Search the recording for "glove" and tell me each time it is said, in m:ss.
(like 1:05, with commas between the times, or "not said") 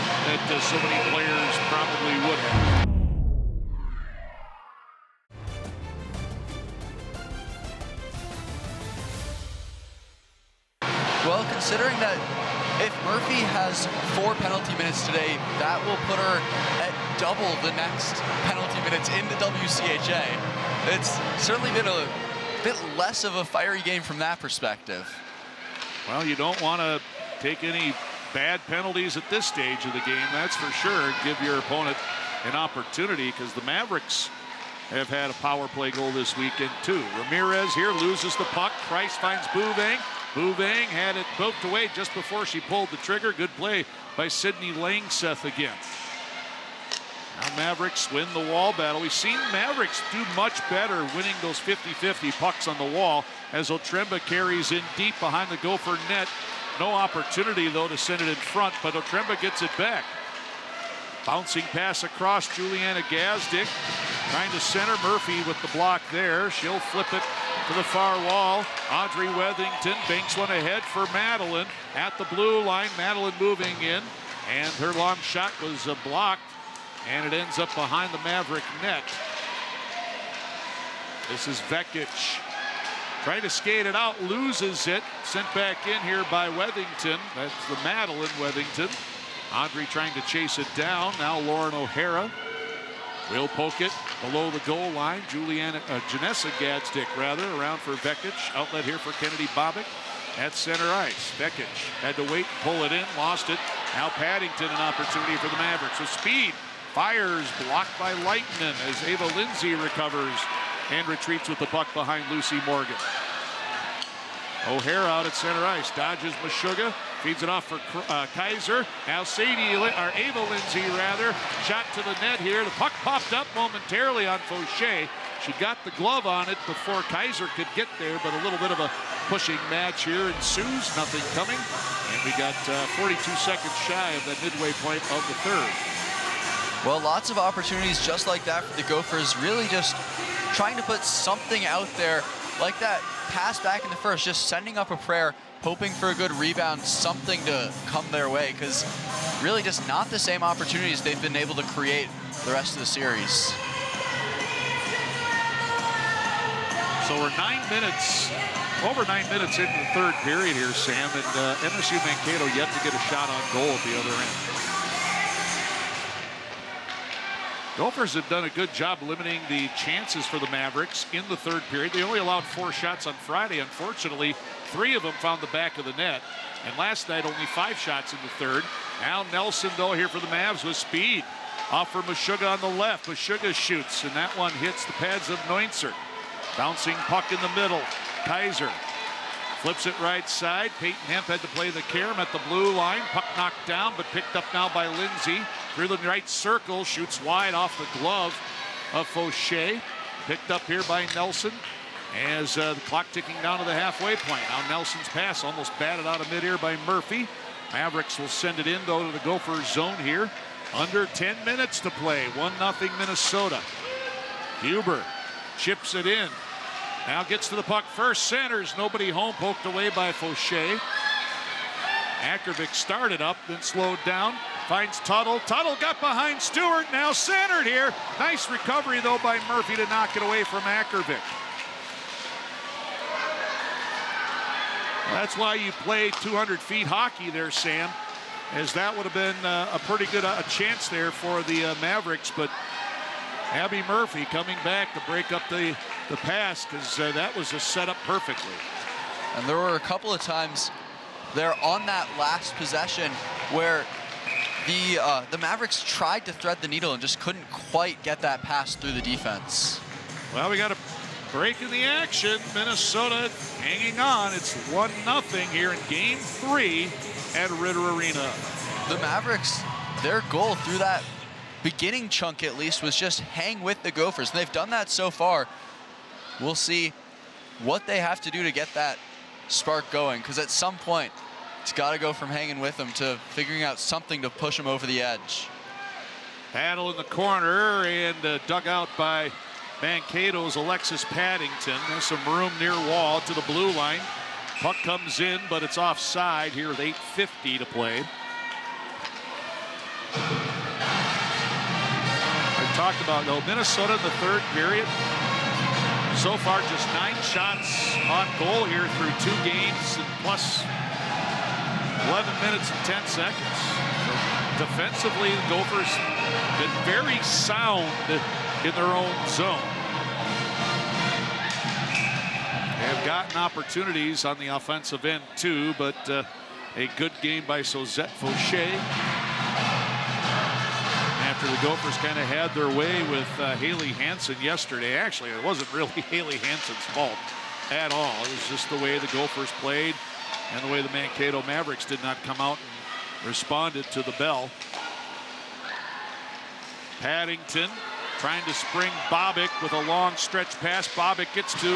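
2:05, 3:17.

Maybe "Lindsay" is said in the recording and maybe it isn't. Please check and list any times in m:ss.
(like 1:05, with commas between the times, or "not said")
1:49, 2:00, 3:14.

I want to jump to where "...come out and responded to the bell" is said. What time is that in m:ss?
5:42.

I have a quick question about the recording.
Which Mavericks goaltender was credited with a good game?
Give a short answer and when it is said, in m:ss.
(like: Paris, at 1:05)
Suzette Fauché, at 5:27.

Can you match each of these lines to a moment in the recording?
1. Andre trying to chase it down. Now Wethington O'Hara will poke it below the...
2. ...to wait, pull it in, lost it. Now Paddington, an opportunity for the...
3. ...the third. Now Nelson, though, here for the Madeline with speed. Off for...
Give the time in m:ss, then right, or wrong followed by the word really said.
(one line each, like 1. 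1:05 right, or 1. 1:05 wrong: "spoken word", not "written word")
1. 1:29 wrong: "Lauren", not "Wethington"
2. 1:42 right
3. 2:58 wrong: "Mavs", not "Madeline".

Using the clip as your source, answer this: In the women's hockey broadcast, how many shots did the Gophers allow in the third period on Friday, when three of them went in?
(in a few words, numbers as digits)
4.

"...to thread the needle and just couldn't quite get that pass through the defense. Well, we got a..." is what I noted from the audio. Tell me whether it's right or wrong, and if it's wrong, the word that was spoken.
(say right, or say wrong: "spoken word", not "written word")
right.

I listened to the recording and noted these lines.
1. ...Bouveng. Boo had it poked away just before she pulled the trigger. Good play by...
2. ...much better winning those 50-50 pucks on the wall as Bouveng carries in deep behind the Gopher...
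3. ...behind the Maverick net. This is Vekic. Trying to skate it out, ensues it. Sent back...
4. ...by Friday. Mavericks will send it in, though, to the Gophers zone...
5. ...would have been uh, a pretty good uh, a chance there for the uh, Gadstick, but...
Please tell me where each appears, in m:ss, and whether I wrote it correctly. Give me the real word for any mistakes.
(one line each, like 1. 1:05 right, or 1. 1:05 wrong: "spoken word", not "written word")
1. 0:39 right
2. 0:50 wrong: "Otremba", not "Bouveng"
3. 1:17 wrong: "loses", not "ensues"
4. 3:26 wrong: "Murphy", not "Friday"
5. 3:58 wrong: "Mavericks", not "Gadstick".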